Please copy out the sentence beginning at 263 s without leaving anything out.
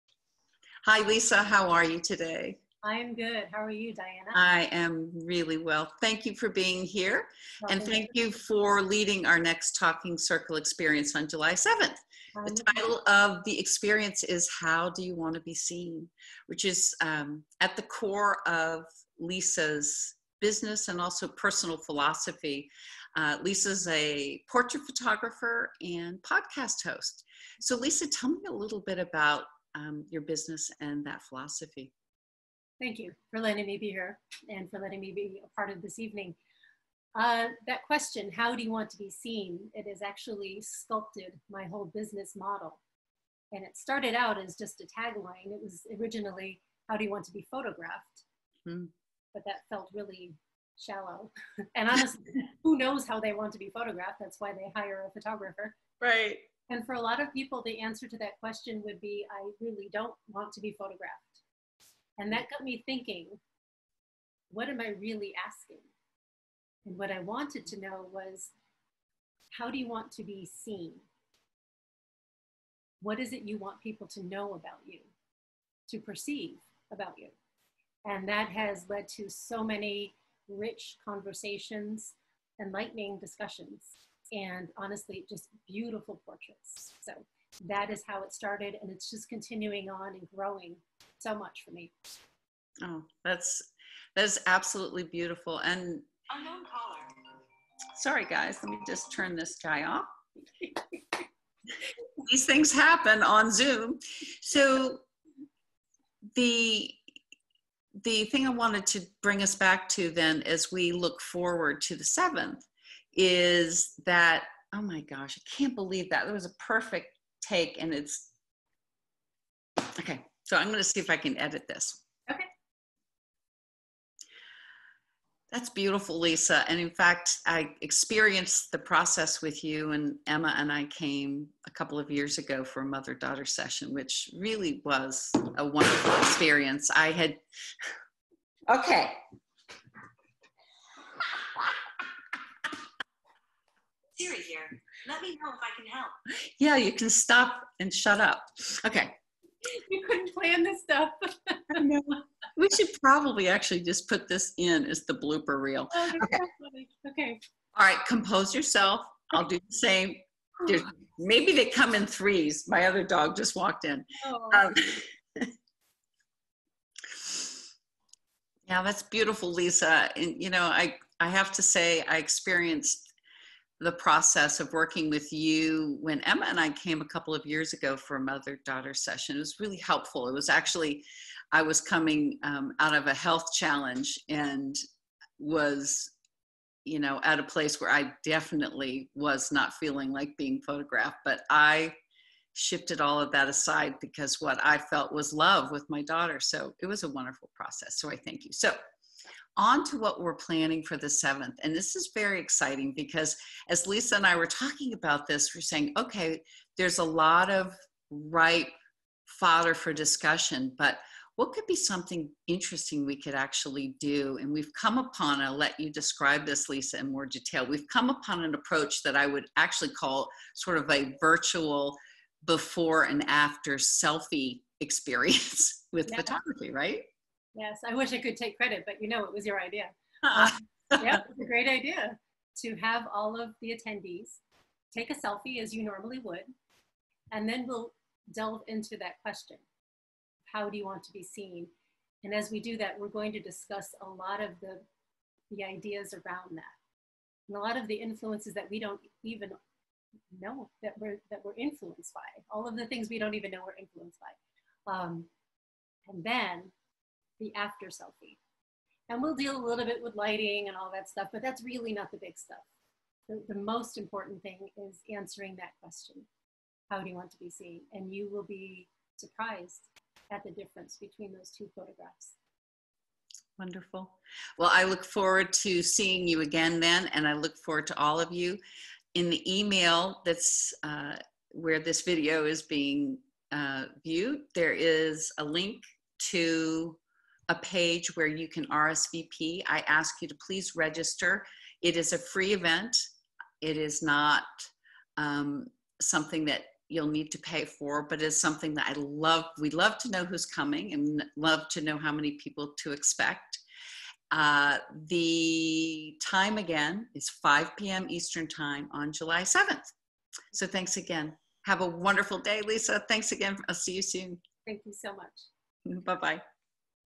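The, the most important thing is answering that question How do you want to be seen?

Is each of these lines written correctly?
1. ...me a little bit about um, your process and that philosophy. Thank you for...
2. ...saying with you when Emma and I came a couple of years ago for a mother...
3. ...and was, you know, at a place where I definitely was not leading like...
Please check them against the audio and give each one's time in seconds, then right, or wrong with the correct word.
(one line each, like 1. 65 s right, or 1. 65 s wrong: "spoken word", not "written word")
1. 28 s wrong: "business", not "process"
2. 174 s wrong: "working", not "saying"
3. 184 s wrong: "feeling", not "leading".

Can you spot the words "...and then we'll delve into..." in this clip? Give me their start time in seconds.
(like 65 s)
237 s.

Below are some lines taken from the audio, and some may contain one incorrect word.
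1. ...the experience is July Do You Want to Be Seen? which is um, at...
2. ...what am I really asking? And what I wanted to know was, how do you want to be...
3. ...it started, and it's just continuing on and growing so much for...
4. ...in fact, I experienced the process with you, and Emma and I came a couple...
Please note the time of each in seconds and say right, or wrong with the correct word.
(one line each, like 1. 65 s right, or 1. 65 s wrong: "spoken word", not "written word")
1. 13 s wrong: "How", not "July"
2. 64 s right
3. 88 s right
4. 126 s right.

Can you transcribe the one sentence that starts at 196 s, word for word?
So it was a wonderful process.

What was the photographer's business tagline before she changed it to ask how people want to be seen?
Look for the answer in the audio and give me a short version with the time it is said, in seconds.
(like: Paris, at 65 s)
How do you want to be photographed?, at 46 s.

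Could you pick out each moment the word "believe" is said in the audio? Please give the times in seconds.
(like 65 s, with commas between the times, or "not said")
115 s.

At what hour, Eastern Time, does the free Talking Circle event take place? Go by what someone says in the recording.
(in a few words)
5 p.m.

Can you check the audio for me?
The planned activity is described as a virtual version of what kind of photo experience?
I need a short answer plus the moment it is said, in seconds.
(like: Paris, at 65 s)
Before and after selfie, at 222 s.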